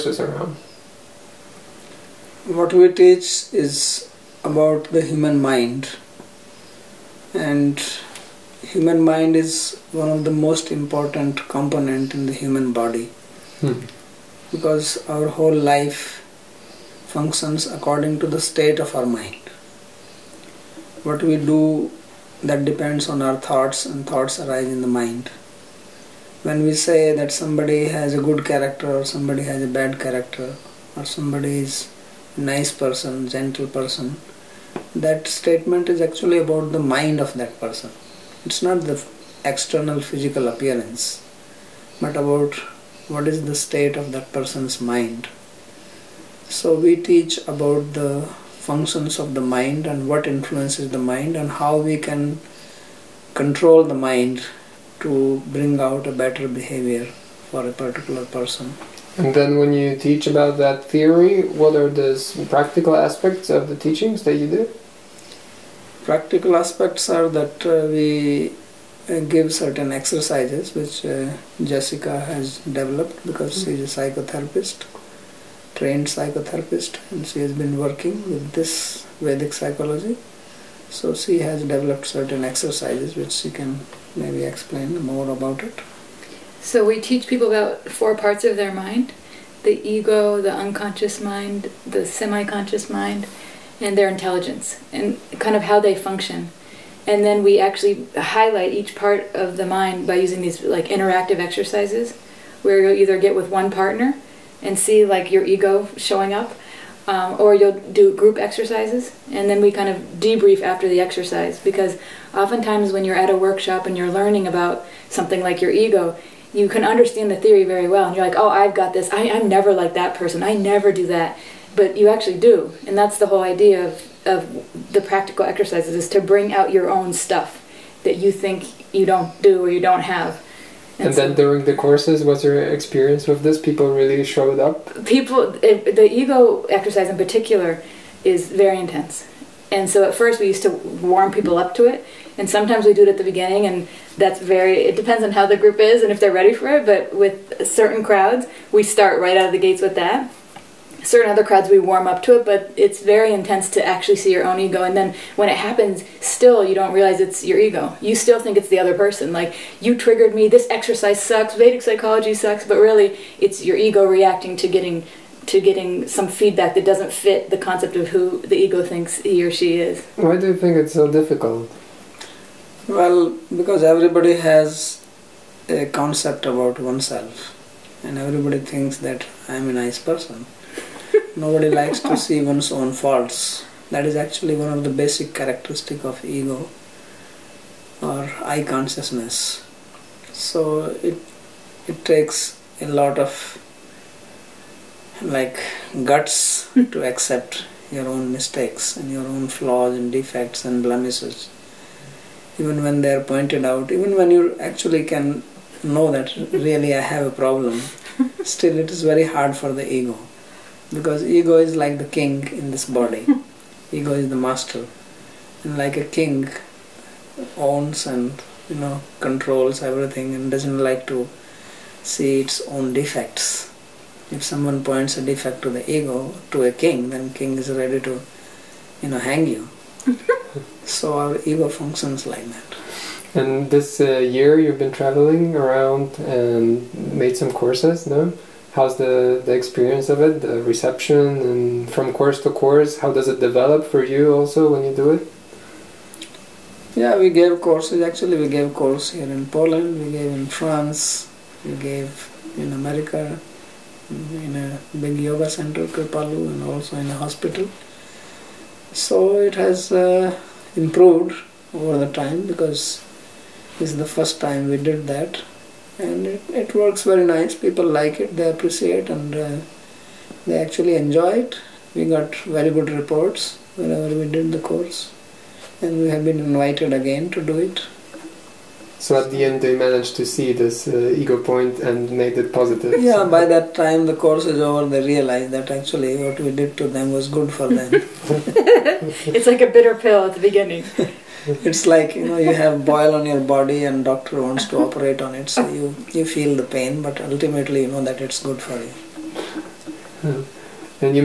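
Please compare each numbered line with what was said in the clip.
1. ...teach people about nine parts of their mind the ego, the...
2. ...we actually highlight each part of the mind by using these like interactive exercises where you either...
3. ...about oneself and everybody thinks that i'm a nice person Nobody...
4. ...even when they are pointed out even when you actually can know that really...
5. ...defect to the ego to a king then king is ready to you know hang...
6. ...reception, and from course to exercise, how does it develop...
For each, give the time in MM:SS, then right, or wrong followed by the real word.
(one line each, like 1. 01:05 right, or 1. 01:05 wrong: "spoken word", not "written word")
1. 01:26 wrong: "four", not "nine"
2. 01:37 right
3. 02:56 right
4. 03:22 right
5. 03:45 right
6. 04:00 wrong: "course", not "exercise".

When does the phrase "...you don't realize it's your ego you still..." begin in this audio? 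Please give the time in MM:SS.
02:36.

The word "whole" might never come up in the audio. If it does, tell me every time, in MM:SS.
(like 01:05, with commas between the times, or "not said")
00:15, 02:03.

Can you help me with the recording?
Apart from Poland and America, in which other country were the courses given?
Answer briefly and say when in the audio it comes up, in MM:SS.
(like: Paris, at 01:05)
France, at 04:10.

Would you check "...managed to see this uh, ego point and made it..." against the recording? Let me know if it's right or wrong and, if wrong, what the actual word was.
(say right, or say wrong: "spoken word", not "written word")
right.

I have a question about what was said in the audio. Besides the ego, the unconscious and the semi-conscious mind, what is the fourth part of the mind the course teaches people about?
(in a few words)
Intelligence.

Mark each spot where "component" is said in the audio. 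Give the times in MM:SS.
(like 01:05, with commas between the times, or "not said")
00:11.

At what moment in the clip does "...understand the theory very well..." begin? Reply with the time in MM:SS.
01:56.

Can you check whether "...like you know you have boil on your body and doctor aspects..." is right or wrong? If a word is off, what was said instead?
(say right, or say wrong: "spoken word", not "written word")
wrong: "wants", not "aspects".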